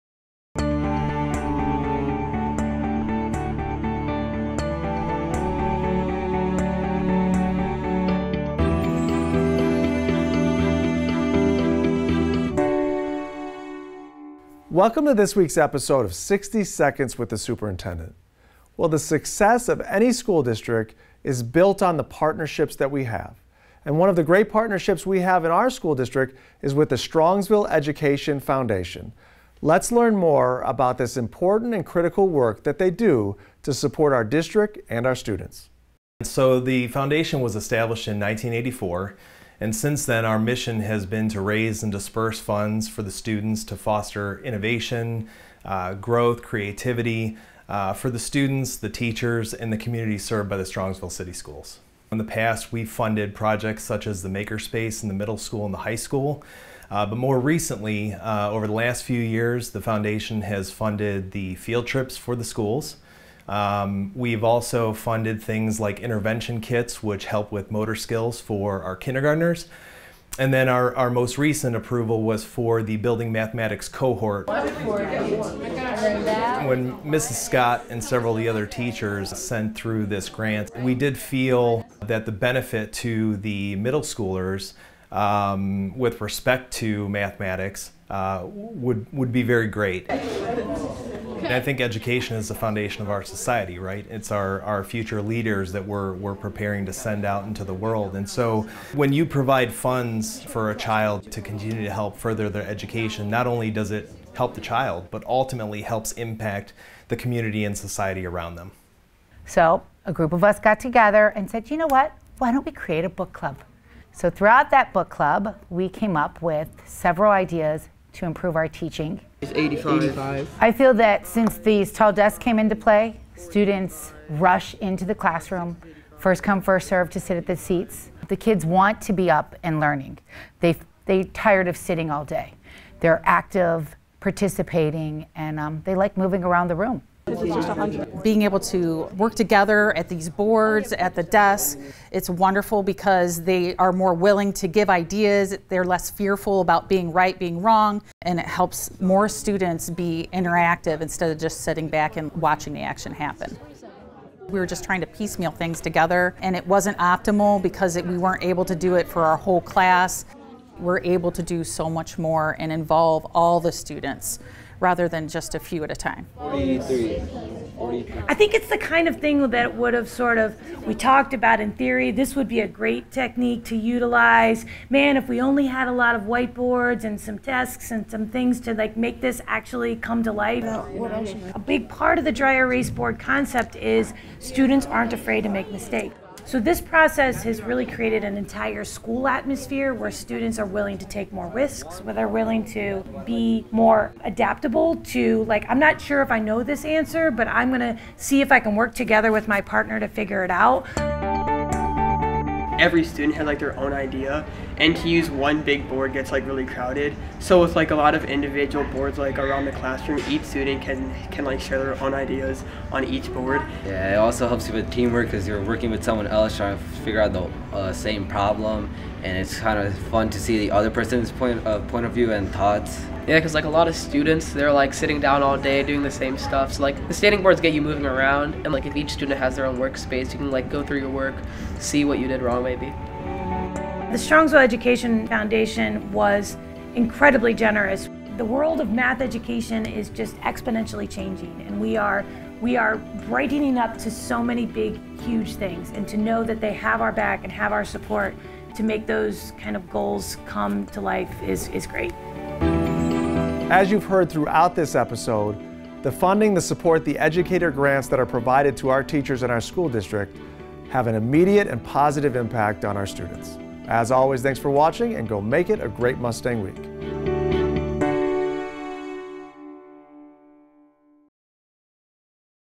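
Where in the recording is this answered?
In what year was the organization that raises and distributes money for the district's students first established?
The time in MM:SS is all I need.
00:38.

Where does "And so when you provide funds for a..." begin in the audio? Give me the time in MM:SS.
01:38.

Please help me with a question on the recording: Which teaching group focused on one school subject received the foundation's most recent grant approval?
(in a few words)
building mathematics cohort.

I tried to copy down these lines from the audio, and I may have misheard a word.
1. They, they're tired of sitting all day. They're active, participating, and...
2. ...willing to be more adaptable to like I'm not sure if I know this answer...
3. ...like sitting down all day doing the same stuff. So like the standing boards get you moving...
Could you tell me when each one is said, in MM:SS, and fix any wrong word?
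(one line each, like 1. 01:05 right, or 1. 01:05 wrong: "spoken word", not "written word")
1. 02:10 right
2. 03:12 right
3. 03:44 right.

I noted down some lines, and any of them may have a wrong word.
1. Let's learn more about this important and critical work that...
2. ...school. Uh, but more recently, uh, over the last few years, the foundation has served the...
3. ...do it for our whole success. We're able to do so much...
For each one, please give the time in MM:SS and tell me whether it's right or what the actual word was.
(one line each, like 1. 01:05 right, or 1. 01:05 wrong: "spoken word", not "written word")
1. 00:29 right
2. 00:55 wrong: "funded", not "served"
3. 02:38 wrong: "class", not "success".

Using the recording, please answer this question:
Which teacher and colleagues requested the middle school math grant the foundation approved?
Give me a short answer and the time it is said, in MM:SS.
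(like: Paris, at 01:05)
Mrs. Scott, at 01:17.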